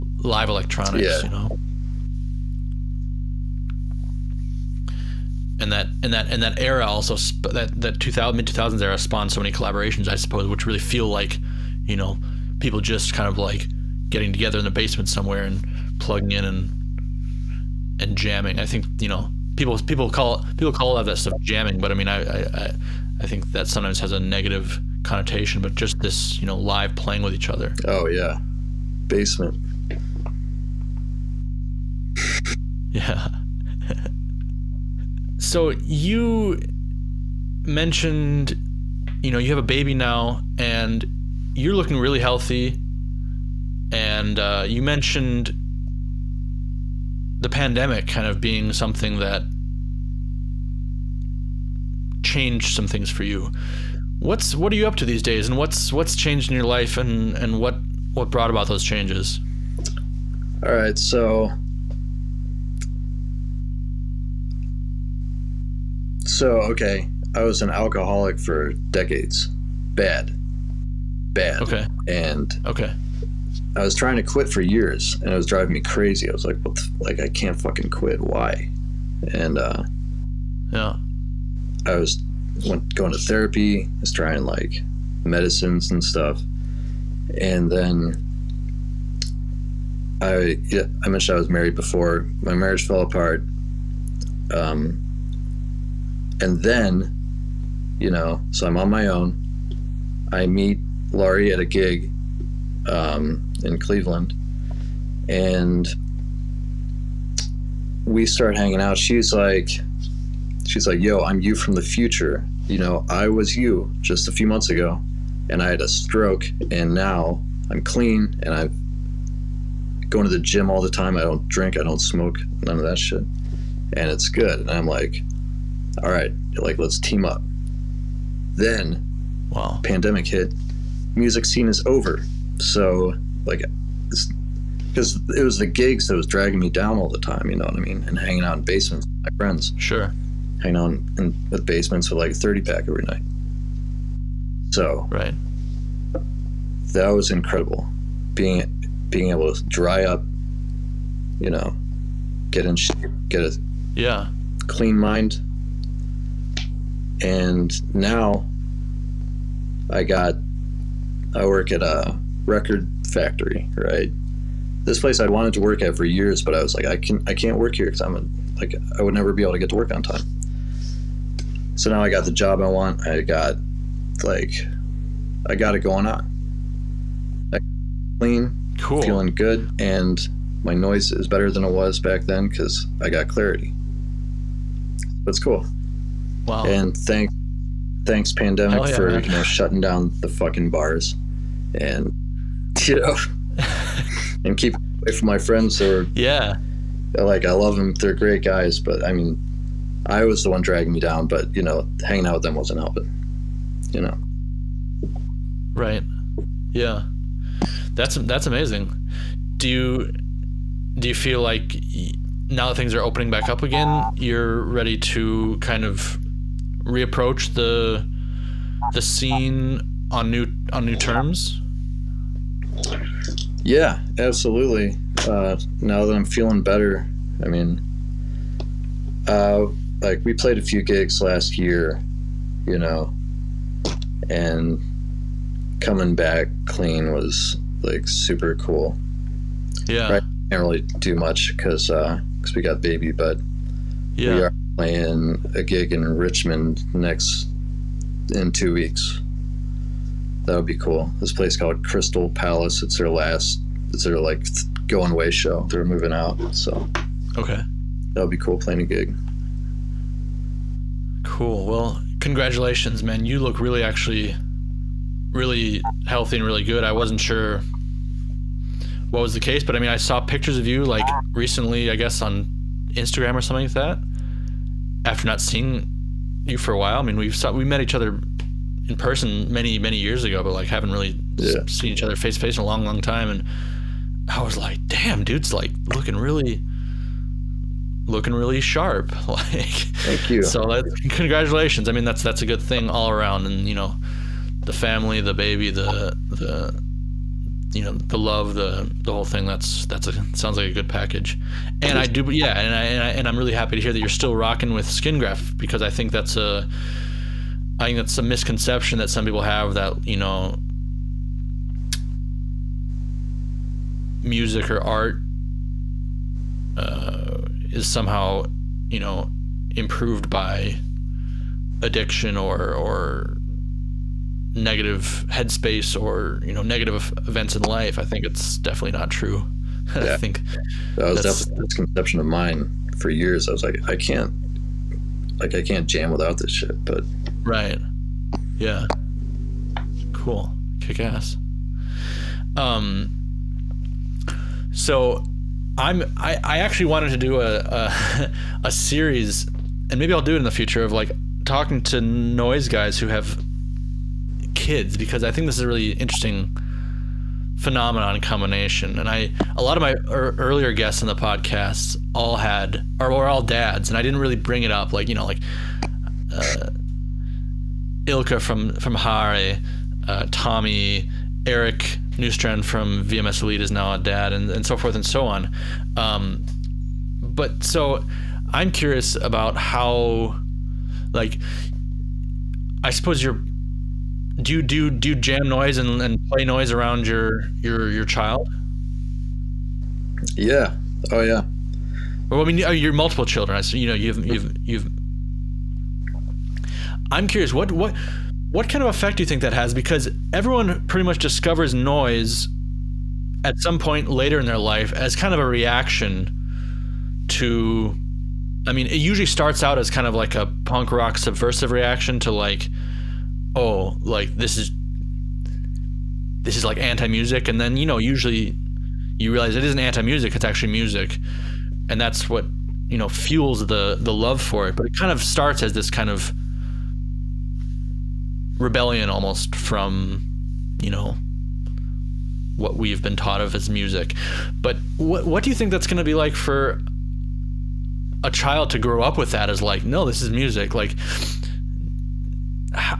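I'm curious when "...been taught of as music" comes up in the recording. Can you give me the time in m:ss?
7:13.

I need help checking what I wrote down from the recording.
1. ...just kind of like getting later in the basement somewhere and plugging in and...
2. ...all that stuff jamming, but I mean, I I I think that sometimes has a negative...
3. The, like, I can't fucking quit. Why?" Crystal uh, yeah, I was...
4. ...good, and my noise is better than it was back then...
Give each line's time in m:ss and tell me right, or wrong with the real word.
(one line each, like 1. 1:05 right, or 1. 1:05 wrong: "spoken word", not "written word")
1. 0:12 wrong: "together", not "later"
2. 0:20 right
3. 1:16 wrong: "And", not "Crystal"
4. 2:59 right.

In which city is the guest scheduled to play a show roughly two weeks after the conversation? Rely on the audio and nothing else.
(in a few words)
Richmond.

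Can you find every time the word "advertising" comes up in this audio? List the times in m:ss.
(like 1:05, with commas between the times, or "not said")
not said.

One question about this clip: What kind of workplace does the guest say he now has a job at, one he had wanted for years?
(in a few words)
A record factory.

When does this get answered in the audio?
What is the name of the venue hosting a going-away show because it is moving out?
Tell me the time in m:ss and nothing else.
4:11.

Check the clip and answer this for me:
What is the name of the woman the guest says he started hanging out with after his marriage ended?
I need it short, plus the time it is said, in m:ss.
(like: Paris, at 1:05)
Laurie, at 1:41.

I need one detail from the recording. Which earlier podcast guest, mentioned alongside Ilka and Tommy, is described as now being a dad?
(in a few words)
Eric Newstrand.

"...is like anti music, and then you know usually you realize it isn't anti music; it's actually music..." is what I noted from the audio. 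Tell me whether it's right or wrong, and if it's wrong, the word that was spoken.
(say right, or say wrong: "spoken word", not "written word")
right.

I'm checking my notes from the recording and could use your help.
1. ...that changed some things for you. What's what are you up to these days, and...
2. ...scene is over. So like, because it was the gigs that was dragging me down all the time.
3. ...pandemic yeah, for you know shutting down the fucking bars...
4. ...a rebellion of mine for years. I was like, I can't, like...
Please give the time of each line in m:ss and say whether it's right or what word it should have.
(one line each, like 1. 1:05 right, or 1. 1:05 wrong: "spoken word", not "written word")
1. 0:49 right
2. 2:11 right
3. 3:08 right
4. 5:31 wrong: "misconception", not "rebellion".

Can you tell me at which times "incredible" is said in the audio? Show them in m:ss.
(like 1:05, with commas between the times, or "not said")
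2:27.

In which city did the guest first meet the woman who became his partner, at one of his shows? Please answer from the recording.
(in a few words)
Cleveland.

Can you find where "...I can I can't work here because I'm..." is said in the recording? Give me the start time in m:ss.
2:46.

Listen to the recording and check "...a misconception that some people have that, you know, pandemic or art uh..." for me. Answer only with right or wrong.
wrong.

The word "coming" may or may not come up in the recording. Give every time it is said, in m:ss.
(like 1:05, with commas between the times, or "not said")
3:55.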